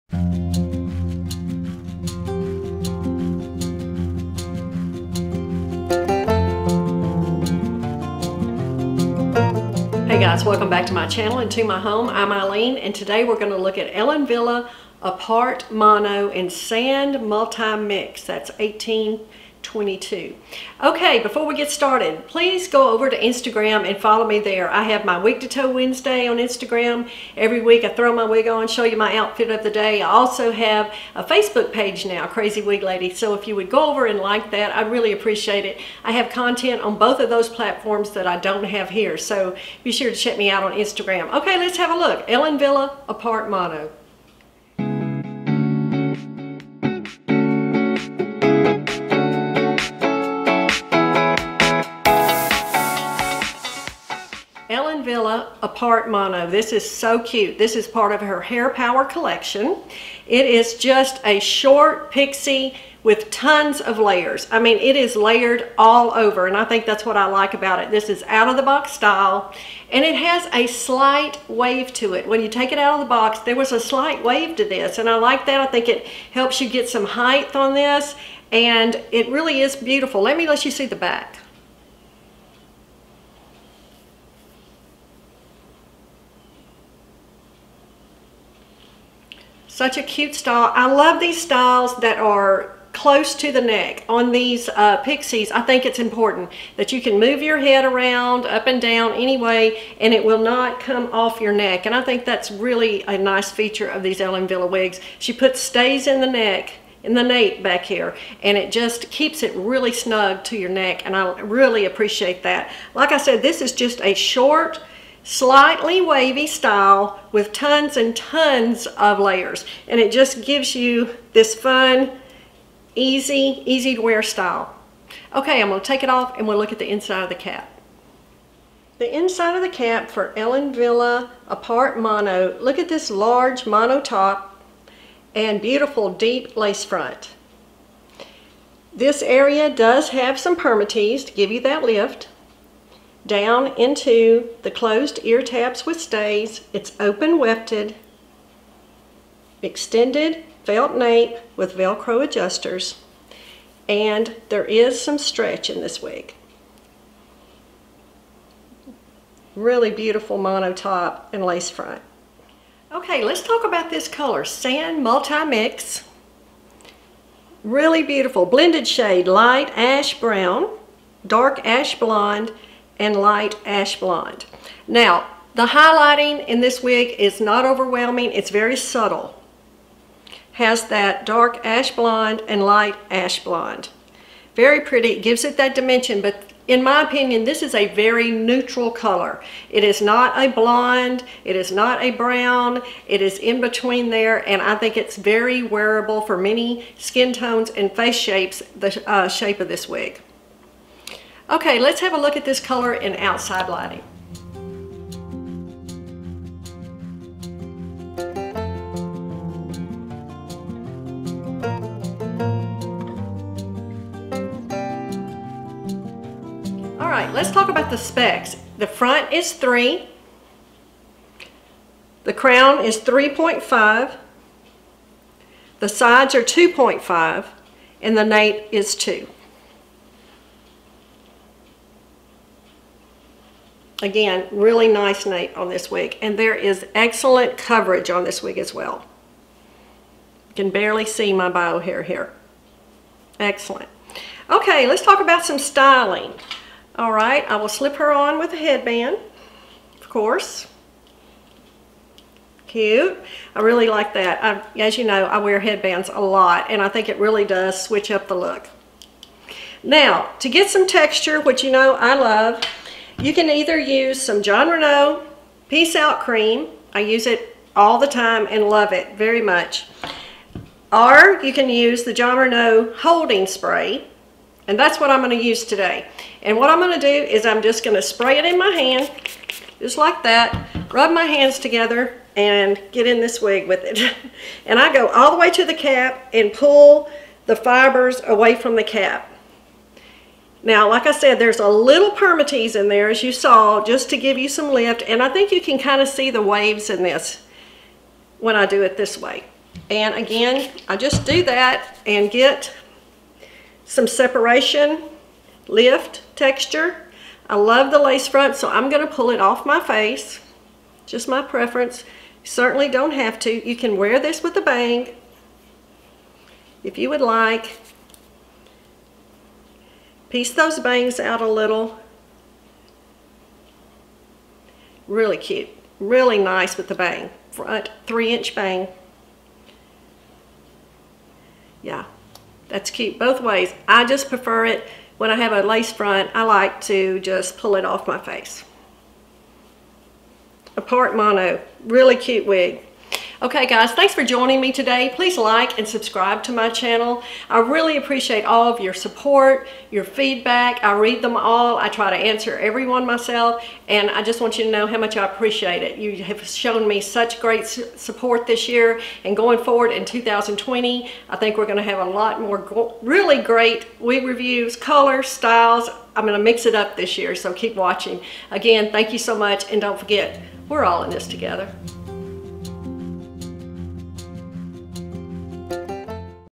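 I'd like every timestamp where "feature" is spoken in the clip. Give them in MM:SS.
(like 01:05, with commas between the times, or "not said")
01:43.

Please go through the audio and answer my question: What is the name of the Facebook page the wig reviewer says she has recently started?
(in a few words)
Crazy Wig Lady.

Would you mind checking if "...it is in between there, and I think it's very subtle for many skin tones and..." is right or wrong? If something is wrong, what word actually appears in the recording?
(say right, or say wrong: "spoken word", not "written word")
wrong: "wearable", not "subtle".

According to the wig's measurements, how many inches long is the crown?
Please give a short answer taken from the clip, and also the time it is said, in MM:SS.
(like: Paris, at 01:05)
3.5, at 03:42.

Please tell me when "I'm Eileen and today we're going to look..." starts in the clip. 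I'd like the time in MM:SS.
00:12.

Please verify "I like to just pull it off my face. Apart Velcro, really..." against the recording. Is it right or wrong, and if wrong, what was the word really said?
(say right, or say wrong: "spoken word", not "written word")
wrong: "Mono", not "Velcro".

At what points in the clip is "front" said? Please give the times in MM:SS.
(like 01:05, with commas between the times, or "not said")
02:16, 02:41, 03:38, 05:08, 05:27, 05:35.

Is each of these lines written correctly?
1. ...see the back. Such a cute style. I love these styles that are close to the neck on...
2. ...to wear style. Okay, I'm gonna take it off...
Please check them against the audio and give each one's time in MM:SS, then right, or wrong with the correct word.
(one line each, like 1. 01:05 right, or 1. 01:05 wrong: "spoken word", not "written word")
1. 01:20 right
2. 02:03 right.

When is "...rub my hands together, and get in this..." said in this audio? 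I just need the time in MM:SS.
04:40.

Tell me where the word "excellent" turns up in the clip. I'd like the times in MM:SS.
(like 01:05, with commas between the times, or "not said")
03:56, 04:03.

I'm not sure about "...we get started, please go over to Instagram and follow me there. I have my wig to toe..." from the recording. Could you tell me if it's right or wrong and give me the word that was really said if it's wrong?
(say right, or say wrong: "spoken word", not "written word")
right.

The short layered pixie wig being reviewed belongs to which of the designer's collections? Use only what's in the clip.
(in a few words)
Hair Power.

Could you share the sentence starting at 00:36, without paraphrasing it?
I have content on both of those platforms that I don't have here.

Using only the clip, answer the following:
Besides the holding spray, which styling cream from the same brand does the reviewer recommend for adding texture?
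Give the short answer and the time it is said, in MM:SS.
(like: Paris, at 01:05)
Peace Out Cream, at 04:25.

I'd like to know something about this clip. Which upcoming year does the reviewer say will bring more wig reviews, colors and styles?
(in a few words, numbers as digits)
2020.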